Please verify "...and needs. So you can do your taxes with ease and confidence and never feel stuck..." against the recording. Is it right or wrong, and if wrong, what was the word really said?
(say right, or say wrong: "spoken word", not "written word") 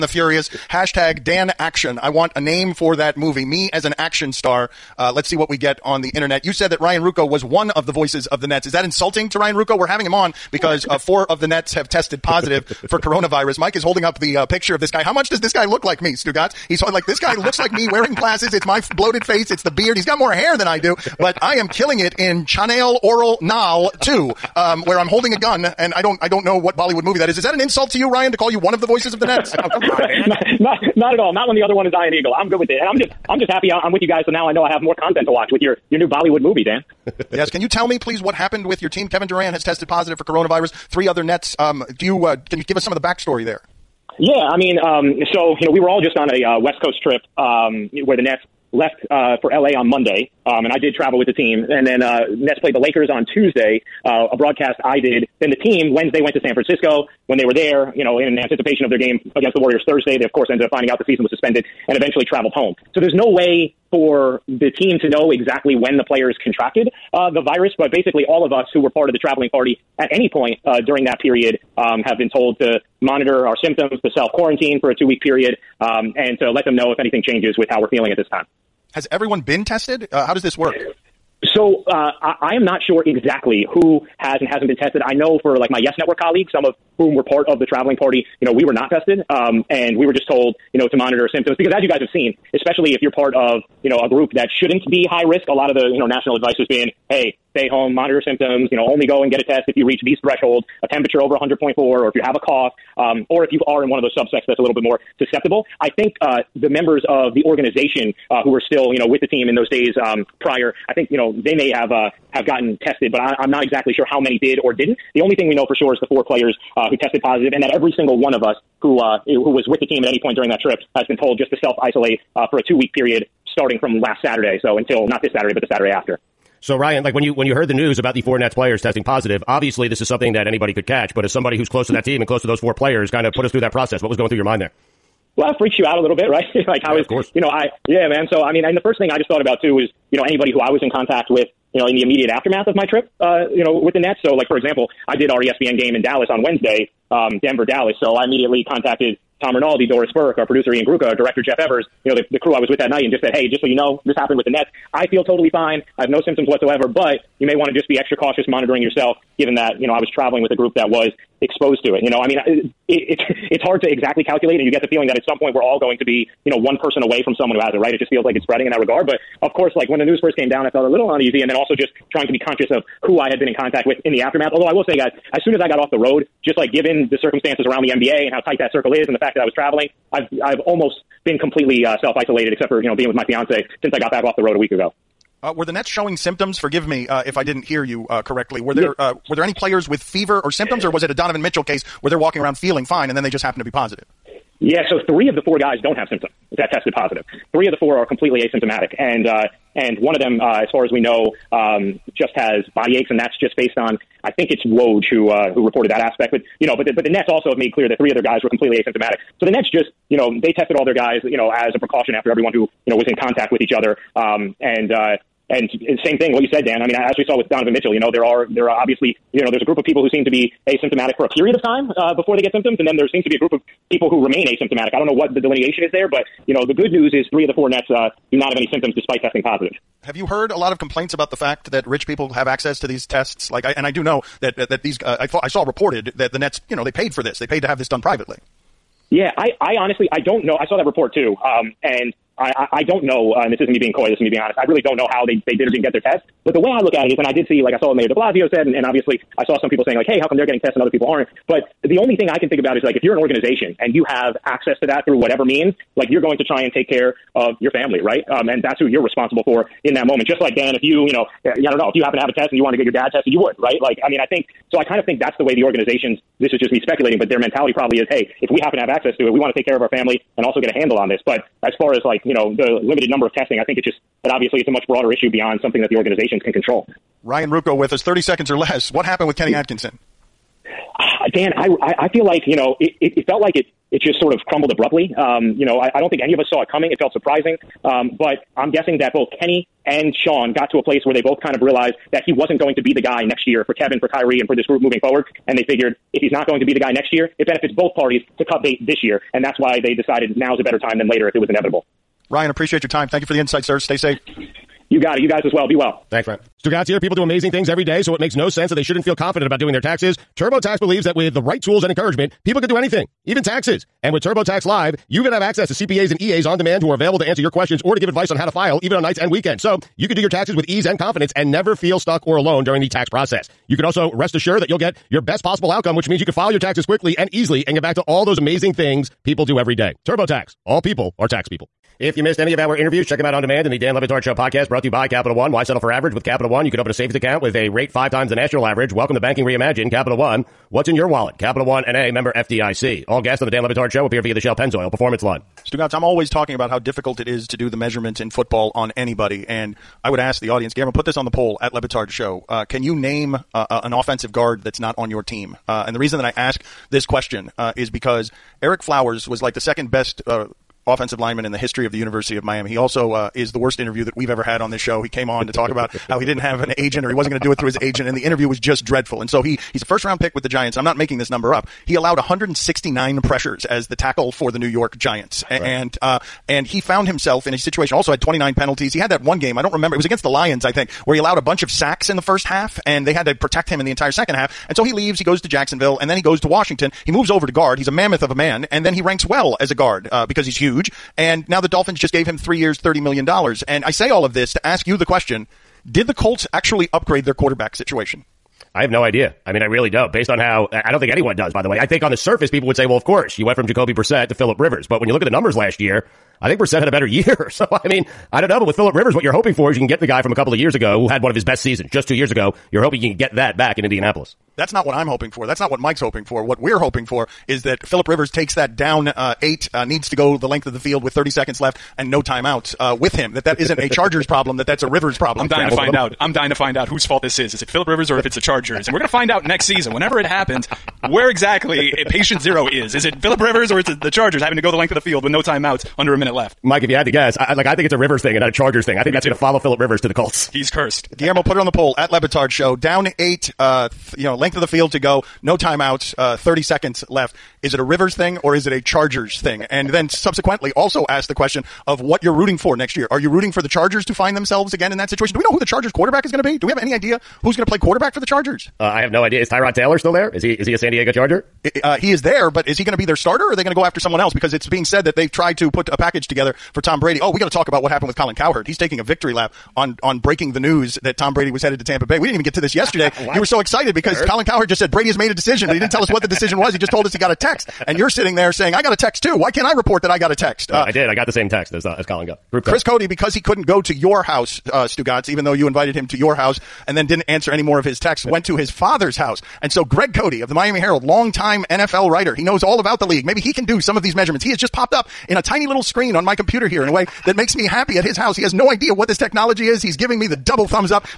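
wrong: "weekends", not "needs".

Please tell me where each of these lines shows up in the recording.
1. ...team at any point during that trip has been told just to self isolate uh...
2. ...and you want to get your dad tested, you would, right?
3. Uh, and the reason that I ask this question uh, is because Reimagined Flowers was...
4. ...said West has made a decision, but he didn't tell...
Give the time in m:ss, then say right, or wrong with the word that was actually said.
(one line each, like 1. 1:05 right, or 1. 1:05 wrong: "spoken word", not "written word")
1. 1:59 right
2. 4:22 right
3. 5:55 wrong: "Ereck", not "Reimagined"
4. 7:54 wrong: "Brady", not "West".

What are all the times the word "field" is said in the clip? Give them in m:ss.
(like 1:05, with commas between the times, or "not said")
7:00, 7:14, 7:24.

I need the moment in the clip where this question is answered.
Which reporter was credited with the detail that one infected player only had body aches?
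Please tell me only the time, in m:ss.
3:24.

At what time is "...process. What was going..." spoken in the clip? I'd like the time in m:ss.
2:13.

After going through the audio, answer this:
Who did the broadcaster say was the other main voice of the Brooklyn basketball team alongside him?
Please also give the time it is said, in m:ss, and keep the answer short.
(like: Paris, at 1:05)
Ian Eagle, at 0:31.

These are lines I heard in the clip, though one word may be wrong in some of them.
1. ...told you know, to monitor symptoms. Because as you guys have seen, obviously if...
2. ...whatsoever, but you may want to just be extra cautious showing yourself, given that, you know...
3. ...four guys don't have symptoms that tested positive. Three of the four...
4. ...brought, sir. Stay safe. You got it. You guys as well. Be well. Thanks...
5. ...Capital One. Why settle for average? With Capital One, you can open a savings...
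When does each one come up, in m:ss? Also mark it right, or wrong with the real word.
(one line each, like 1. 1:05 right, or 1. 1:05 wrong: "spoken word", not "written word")
1. 1:30 wrong: "especially", not "obviously"
2. 2:36 wrong: "monitoring", not "showing"
3. 3:15 right
4. 5:03 wrong: "insight", not "brought"
5. 5:35 right.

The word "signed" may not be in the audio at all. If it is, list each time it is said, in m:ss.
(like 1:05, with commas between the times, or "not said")
not said.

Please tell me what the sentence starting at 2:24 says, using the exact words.
So, like, for example, I did our ESPN game in Dallas on Wednesday, um, Denver, Dallas.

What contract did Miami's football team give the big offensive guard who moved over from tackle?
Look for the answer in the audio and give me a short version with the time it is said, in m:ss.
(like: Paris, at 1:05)
3 years, $30 million, at 6:32.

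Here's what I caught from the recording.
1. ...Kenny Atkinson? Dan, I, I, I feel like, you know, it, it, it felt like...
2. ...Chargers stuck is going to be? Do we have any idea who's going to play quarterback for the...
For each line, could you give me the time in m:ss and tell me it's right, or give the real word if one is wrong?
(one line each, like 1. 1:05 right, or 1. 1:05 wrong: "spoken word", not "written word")
1. 4:39 right
2. 7:35 wrong: "quarterback", not "stuck".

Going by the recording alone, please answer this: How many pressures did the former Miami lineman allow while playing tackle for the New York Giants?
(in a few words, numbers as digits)
169.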